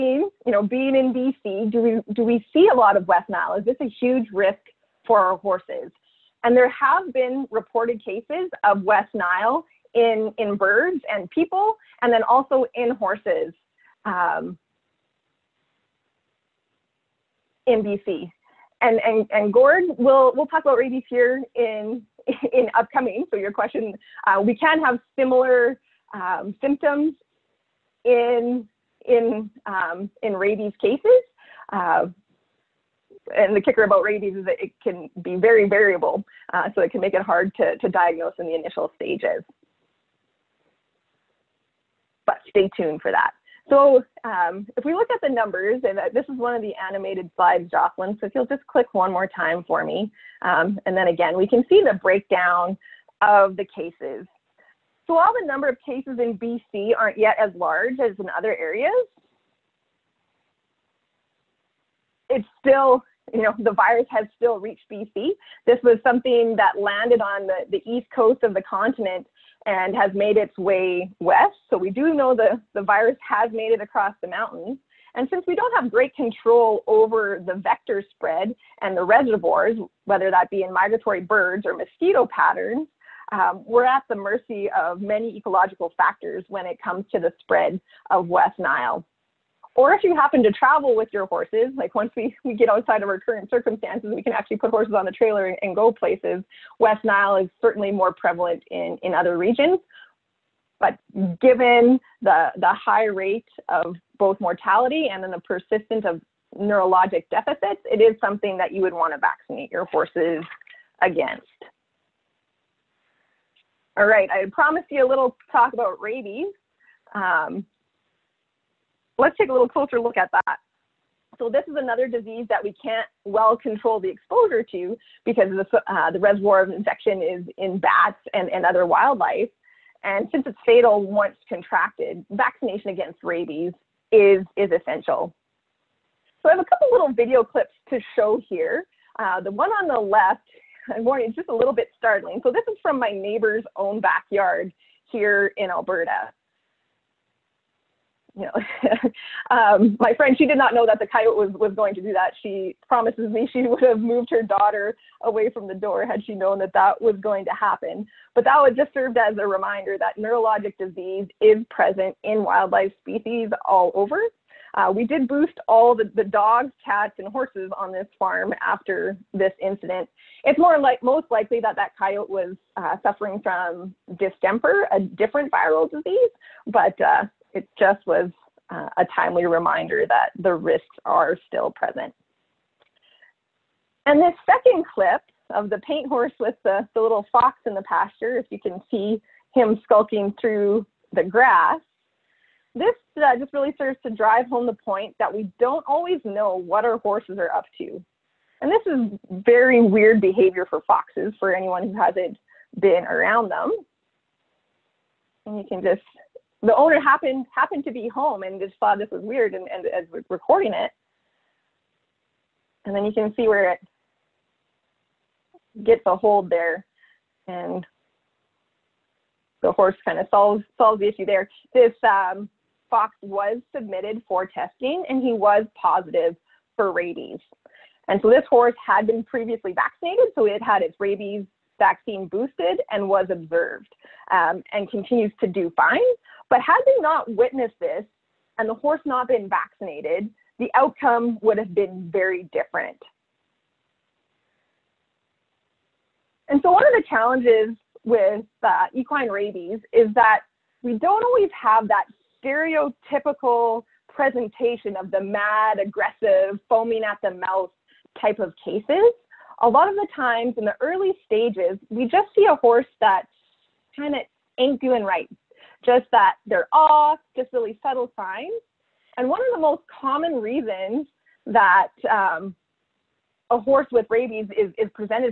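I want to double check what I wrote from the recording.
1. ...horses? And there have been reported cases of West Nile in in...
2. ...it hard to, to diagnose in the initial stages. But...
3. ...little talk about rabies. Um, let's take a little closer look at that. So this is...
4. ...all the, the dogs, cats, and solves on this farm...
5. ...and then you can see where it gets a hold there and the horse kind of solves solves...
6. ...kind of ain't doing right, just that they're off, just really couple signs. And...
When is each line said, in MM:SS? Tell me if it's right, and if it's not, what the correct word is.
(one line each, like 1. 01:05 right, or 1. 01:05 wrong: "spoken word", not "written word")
1. 00:05 right
2. 00:37 right
3. 01:55 right
4. 02:45 wrong: "horses", not "solves"
5. 03:32 right
6. 04:23 wrong: "subtle", not "couple".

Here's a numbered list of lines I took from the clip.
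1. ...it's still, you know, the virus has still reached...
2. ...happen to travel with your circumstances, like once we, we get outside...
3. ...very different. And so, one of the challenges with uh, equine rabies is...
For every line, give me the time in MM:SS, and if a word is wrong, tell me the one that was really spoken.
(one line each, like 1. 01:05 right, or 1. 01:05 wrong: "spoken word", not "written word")
1. 01:02 right
2. 01:30 wrong: "horses", not "circumstances"
3. 04:02 right.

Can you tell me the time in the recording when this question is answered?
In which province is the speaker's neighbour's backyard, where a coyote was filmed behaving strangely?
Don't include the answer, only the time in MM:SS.
02:25.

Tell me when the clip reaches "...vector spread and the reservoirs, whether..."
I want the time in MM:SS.
01:17.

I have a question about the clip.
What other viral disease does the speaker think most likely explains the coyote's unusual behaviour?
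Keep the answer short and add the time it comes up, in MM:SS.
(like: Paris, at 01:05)
Distemper, at 02:54.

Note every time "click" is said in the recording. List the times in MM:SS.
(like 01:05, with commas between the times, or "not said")
00:48.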